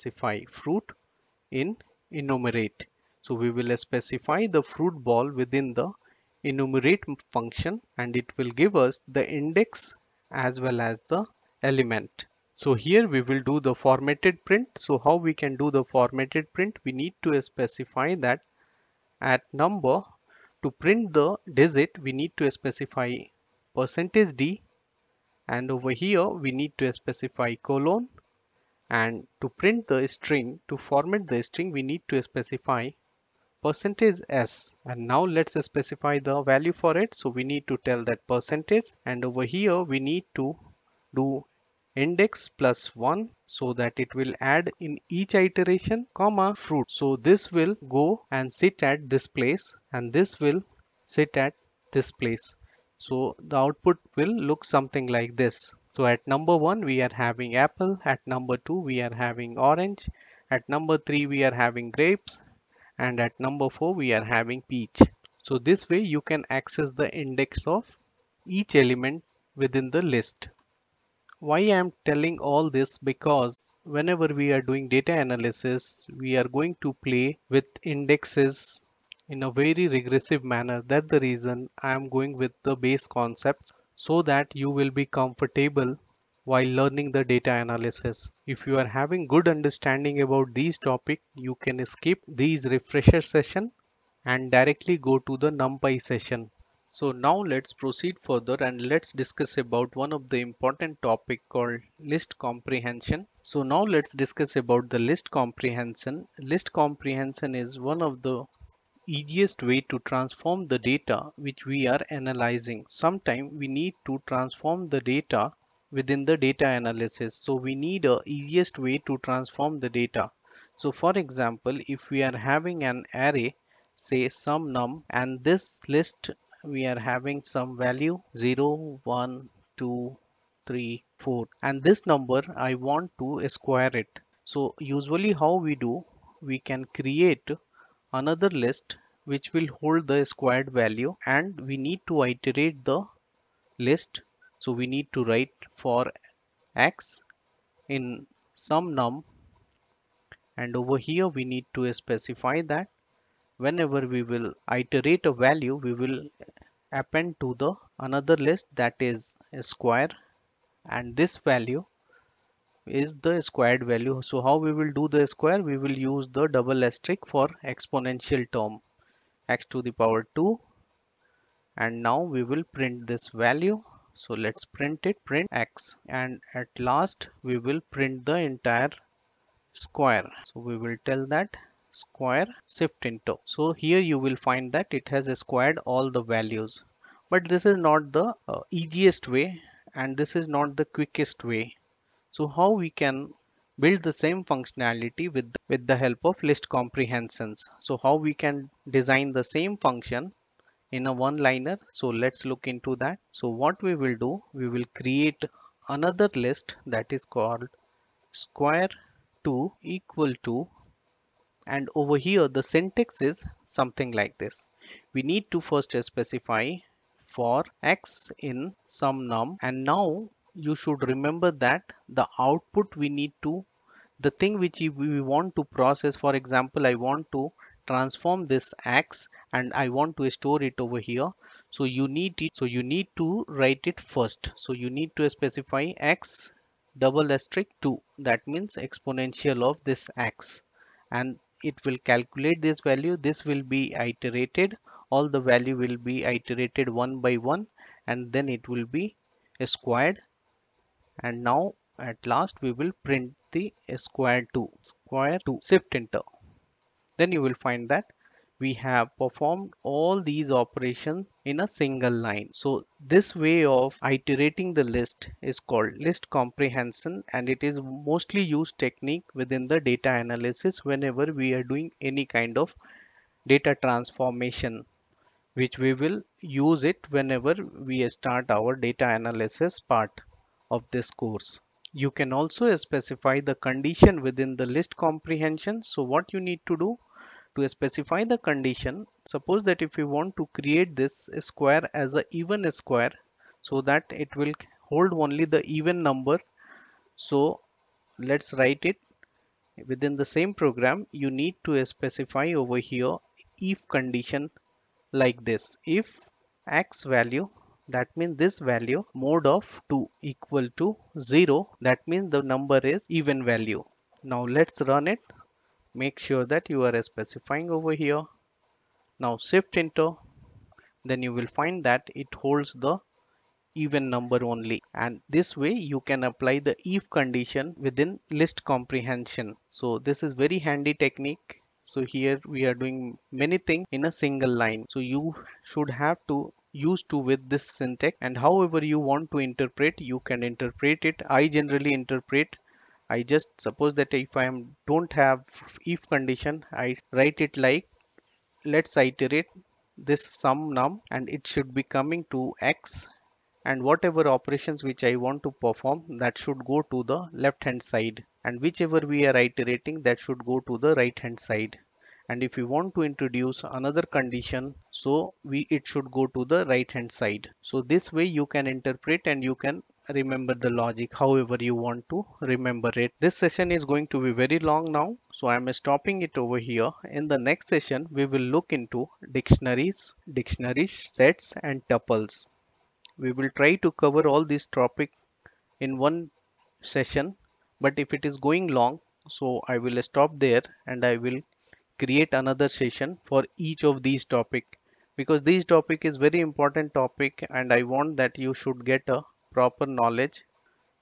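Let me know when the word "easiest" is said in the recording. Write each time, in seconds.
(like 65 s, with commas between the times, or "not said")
109 s, 118 s, 188 s.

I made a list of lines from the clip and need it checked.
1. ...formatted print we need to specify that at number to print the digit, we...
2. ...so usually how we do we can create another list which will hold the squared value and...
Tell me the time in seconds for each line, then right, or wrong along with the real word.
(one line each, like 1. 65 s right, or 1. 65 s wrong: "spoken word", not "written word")
1. 15 s right
2. 134 s right.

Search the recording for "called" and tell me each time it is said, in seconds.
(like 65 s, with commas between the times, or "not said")
101 s, 207 s, 265 s.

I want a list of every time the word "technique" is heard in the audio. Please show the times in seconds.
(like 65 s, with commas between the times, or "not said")
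268 s, 331 s.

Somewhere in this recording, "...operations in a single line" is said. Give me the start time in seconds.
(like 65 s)
260 s.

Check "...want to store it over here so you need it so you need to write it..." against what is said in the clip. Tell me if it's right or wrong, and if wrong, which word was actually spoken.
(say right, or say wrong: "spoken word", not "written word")
right.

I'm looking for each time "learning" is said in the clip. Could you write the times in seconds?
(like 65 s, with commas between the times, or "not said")
86 s.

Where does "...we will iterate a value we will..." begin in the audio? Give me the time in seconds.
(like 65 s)
154 s.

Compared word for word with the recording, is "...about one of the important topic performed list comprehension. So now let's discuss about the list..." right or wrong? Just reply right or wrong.
wrong.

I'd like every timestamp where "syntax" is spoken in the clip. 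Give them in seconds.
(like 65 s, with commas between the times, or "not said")
212 s, 337 s.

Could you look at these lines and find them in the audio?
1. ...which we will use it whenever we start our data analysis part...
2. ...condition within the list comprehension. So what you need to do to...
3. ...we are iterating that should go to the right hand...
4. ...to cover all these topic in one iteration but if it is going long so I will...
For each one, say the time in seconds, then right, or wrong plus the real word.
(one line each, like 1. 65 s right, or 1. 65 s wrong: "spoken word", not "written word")
1. 275 s right
2. 283 s right
3. 358 s right
4. 383 s wrong: "session", not "iteration".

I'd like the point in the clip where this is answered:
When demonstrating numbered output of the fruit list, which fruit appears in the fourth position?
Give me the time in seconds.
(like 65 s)
64 s.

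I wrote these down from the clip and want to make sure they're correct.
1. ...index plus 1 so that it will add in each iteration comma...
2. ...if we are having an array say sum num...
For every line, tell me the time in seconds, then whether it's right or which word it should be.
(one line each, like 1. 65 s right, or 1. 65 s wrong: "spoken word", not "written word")
1. 42 s right
2. 121 s right.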